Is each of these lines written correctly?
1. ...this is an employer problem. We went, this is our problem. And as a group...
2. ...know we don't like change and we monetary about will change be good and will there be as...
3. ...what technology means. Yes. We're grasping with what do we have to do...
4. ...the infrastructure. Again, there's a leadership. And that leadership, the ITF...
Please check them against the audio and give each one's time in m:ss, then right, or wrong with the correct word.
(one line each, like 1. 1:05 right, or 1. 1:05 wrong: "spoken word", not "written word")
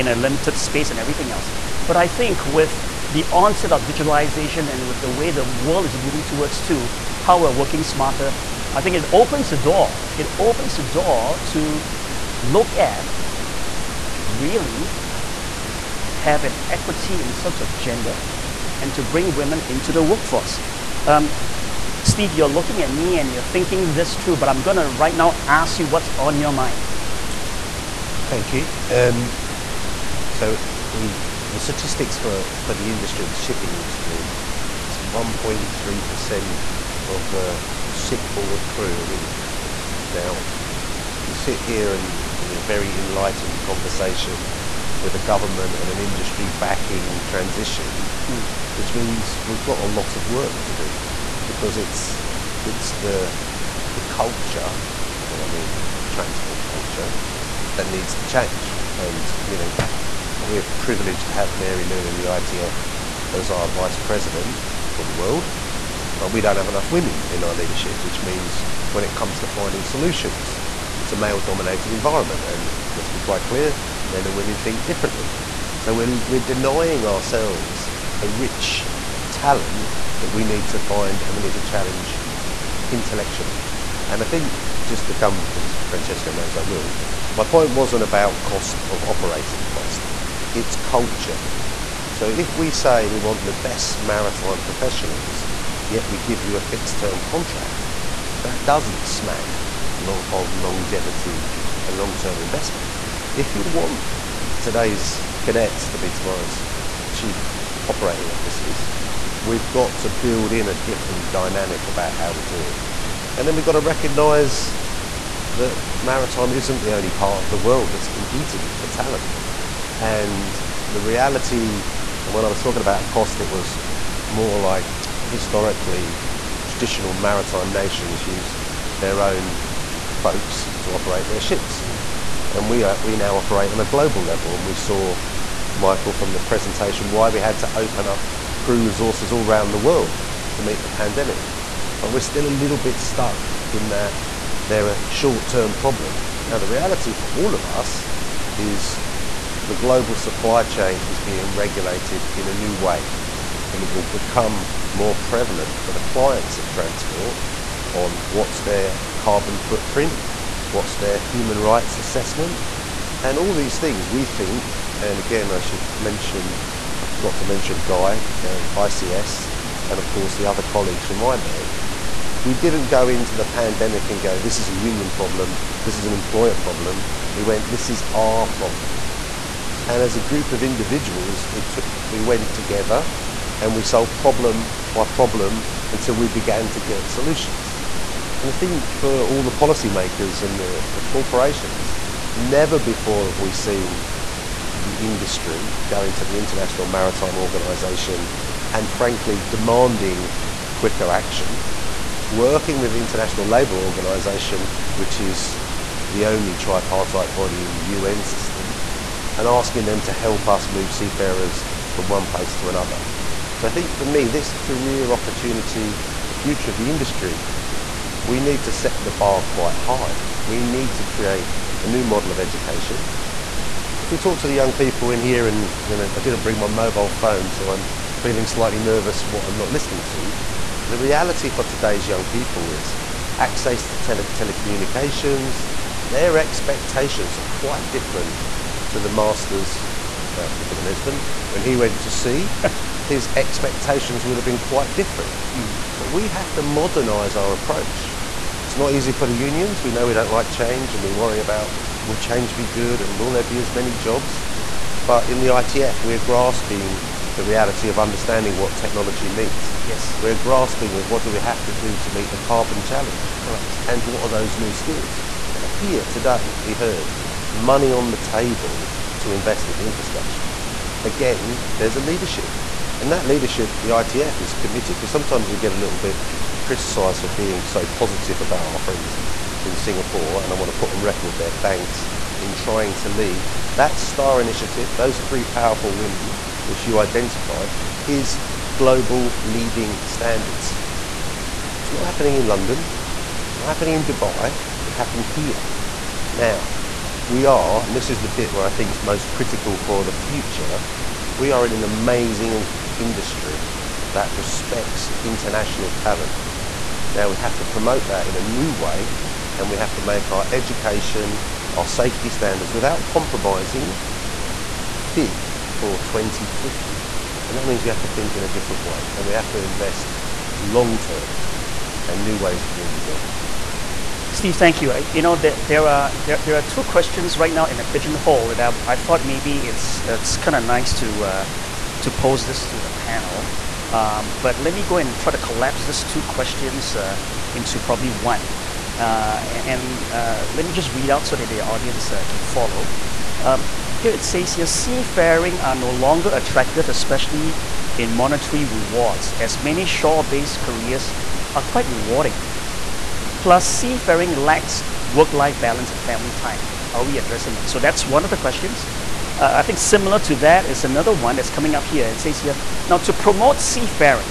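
1. 2:55 right
2. 4:09 wrong: "worry", not "monetary"
3. 4:18 right
4. 4:29 right.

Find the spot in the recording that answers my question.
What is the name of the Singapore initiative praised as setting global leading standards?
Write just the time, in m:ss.
4:43.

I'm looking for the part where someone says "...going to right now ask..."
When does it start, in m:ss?
0:24.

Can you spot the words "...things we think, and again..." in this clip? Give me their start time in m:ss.
2:43.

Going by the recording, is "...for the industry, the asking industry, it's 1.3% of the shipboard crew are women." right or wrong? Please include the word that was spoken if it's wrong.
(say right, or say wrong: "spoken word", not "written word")
wrong: "shipping", not "asking".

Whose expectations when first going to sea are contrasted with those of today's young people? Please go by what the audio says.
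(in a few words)
Esben.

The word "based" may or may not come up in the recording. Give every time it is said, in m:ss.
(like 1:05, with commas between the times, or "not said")
5:49.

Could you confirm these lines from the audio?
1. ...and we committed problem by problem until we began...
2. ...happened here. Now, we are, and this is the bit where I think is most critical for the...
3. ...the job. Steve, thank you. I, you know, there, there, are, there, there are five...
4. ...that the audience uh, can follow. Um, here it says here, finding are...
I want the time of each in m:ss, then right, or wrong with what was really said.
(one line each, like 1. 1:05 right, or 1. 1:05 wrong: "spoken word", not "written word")
1. 3:03 wrong: "solved", not "committed"
2. 4:54 right
3. 5:22 wrong: "two", not "five"
4. 5:41 wrong: "seafaring", not "finding".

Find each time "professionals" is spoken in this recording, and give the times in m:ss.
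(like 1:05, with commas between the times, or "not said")
1:34.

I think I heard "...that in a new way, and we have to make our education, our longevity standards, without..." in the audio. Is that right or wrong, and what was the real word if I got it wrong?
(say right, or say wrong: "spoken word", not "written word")
wrong: "safety", not "longevity".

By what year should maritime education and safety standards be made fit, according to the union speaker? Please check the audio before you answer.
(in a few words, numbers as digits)
2050.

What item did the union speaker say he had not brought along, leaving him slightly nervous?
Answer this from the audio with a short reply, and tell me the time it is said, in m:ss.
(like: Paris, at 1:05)
mobile phone, at 3:46.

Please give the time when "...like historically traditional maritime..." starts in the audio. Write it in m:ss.
2:04.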